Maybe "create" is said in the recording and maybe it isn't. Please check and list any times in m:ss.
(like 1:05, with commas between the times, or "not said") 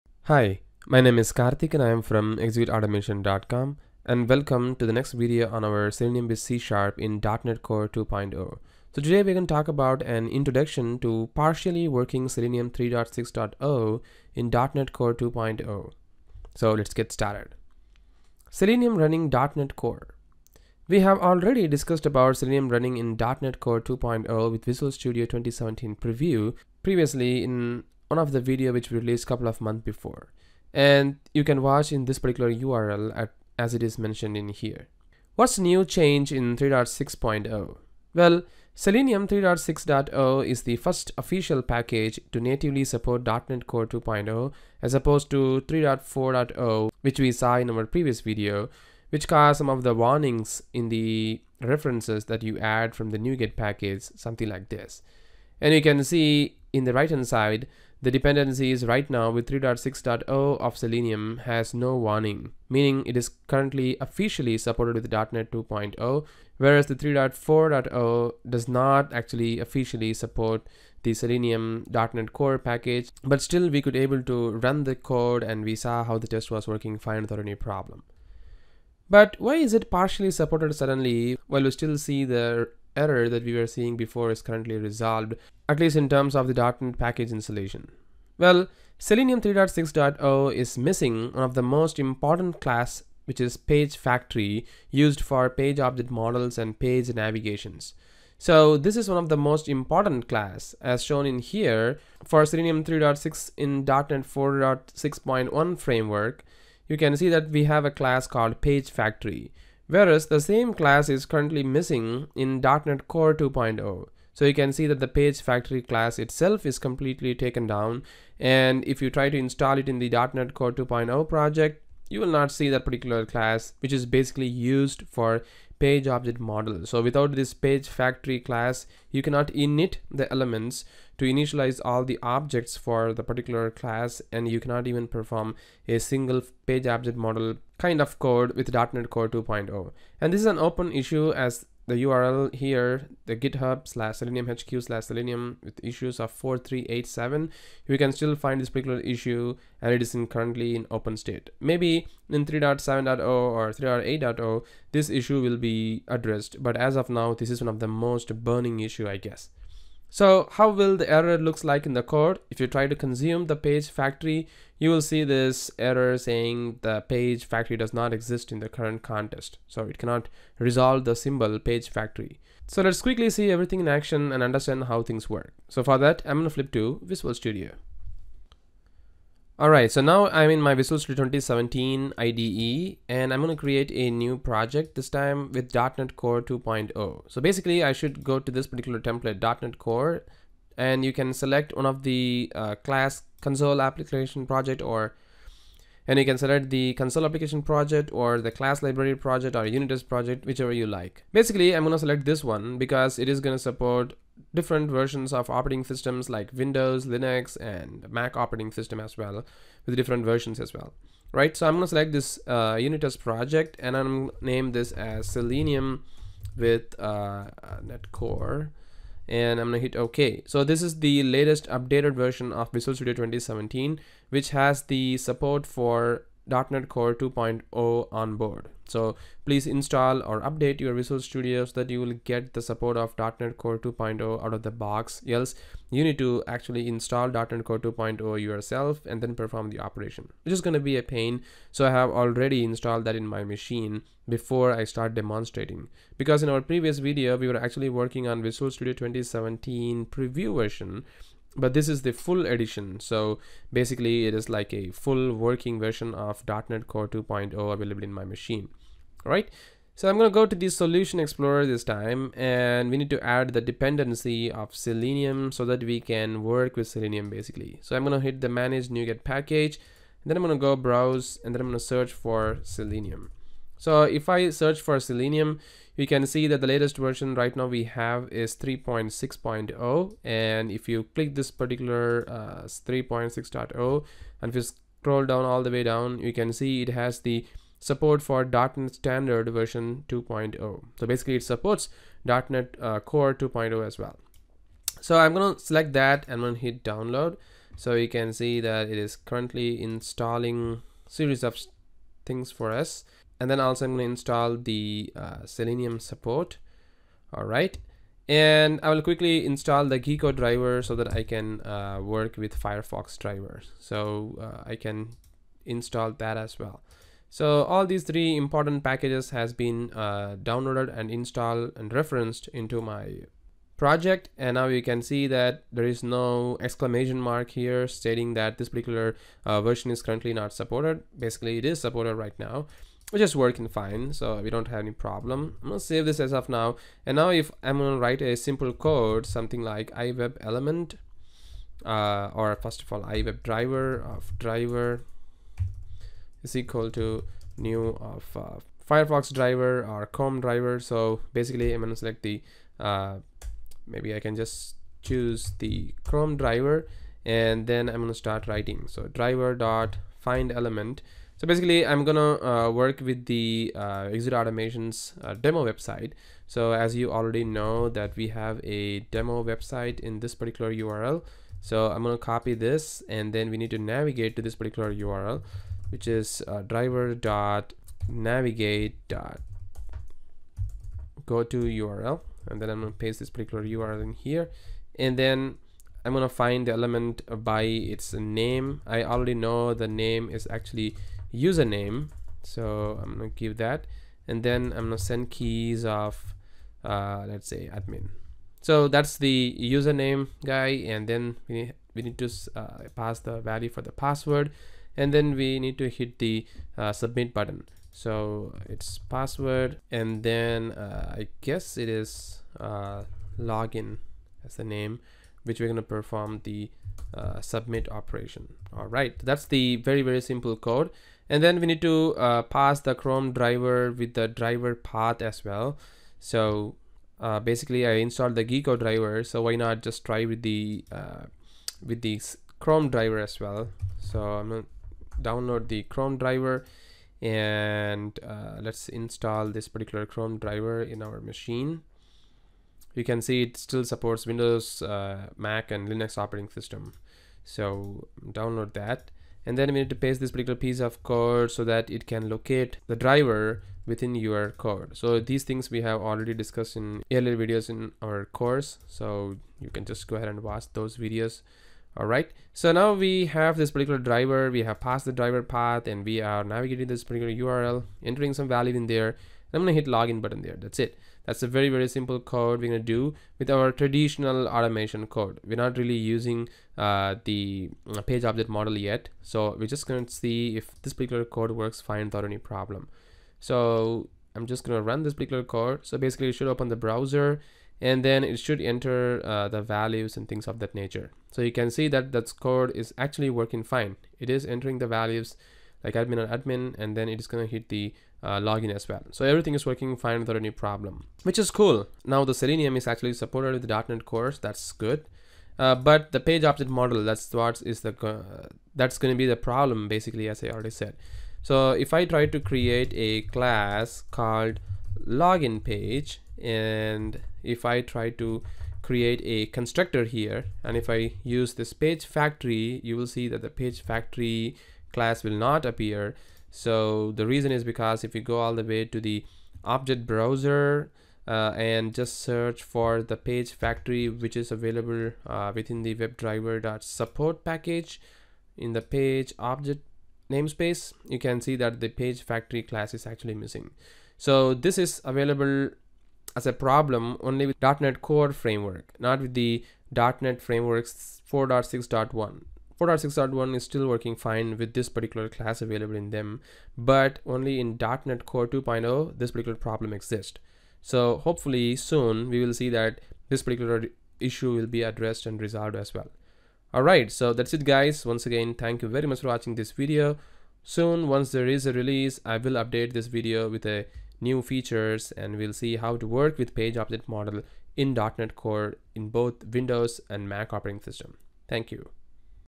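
3:03, 8:32, 8:38.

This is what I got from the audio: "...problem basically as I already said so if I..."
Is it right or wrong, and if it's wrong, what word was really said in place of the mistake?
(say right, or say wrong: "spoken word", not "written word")
right.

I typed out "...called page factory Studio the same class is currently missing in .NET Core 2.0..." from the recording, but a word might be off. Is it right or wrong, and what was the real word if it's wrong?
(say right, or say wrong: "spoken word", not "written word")
wrong: "Whereas", not "Studio".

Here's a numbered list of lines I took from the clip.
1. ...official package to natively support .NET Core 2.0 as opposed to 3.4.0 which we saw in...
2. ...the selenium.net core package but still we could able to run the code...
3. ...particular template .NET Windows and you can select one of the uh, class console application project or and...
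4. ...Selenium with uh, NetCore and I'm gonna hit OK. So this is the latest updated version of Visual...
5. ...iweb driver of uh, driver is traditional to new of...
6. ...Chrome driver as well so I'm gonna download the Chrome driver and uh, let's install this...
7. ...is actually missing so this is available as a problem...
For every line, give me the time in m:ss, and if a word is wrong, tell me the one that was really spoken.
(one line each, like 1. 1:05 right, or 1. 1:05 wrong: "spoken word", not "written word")
1. 0:41 right
2. 1:11 right
3. 3:08 wrong: "Core", not "Windows"
4. 3:35 right
5. 5:43 wrong: "equal", not "traditional"
6. 7:12 right
7. 9:02 right.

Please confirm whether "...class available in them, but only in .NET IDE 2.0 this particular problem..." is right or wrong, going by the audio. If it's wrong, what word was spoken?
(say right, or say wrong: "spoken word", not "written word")
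wrong: "Core", not "IDE".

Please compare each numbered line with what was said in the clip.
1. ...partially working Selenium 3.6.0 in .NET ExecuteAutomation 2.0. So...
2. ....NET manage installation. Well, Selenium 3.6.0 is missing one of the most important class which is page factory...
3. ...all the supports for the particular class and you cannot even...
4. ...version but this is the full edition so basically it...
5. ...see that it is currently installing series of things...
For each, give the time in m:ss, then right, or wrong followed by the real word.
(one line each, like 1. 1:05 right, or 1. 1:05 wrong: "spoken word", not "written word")
1. 0:11 wrong: "Core", not "ExecuteAutomation"
2. 1:26 wrong: "package", not "manage"
3. 2:11 wrong: "objects", not "supports"
4. 4:10 right
5. 4:58 right.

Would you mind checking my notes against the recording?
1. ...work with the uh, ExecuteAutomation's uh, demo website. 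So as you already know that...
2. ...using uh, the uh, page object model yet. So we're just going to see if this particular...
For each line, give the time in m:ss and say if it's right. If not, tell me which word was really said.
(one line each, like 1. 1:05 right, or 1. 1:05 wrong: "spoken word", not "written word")
1. 6:02 right
2. 7:55 right.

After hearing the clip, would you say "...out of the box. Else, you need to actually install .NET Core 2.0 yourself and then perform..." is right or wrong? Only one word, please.
right.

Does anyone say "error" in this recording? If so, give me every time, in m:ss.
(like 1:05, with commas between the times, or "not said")
1:22, 2:41, 2:45.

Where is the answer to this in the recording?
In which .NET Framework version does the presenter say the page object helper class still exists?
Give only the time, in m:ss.
1:43.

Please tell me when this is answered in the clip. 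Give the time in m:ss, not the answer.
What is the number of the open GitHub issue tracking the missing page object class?
2:26.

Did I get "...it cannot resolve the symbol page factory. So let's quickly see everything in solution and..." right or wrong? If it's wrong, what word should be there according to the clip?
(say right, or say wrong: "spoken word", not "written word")
wrong: "action", not "solution".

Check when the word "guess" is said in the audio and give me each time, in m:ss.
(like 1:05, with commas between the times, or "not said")
2:39, 6:51.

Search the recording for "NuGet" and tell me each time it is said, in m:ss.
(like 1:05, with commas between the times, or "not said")
0:53, 4:28.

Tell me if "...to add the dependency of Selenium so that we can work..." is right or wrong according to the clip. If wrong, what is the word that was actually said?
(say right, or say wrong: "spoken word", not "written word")
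right.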